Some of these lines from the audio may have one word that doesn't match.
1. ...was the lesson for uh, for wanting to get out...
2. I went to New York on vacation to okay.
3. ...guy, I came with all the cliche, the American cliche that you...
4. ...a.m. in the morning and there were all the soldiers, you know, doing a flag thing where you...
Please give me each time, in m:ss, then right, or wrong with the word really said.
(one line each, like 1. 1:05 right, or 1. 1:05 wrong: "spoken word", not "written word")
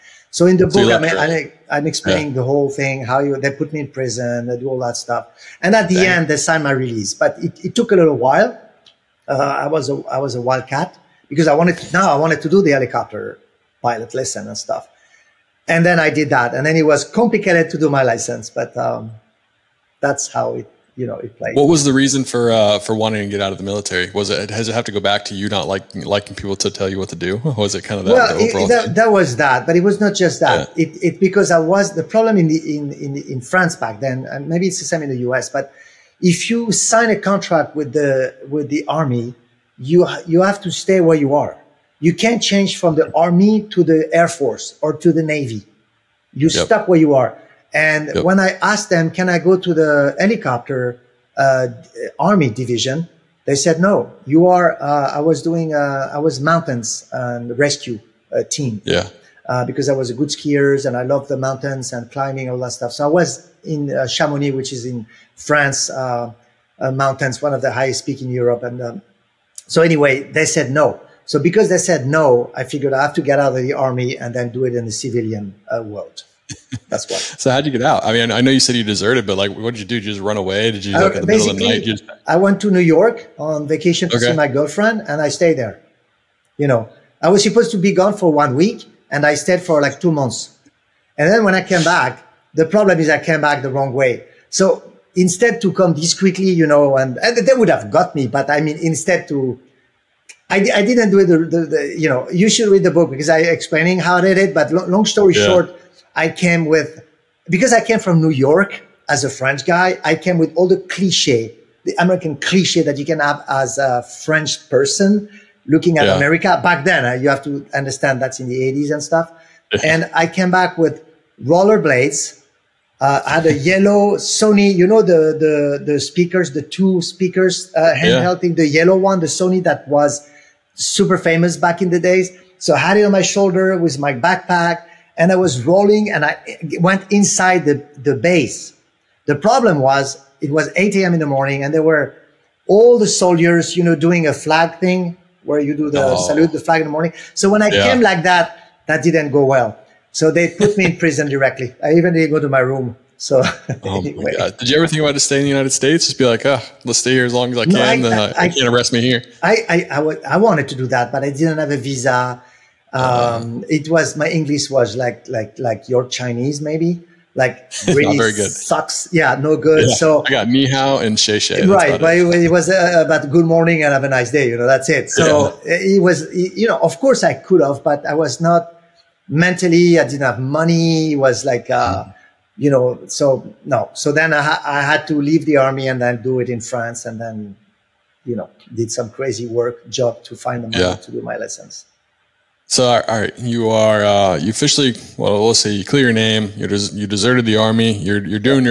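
1. 0:21 wrong: "reason", not "lesson"
2. 1:22 right
3. 1:49 right
4. 2:20 right.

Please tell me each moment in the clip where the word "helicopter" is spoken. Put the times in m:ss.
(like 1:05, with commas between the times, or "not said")
0:12, 0:50.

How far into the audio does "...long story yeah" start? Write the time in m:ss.
1:44.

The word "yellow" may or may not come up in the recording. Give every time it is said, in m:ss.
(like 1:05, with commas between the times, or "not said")
2:03, 2:08.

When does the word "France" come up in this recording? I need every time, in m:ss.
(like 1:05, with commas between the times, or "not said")
0:33, 1:05, 3:06.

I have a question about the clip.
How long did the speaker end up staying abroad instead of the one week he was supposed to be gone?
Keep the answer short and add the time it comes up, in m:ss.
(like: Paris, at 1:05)
2 months, at 1:29.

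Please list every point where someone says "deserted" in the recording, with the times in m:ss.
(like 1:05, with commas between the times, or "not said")
1:18, 3:17.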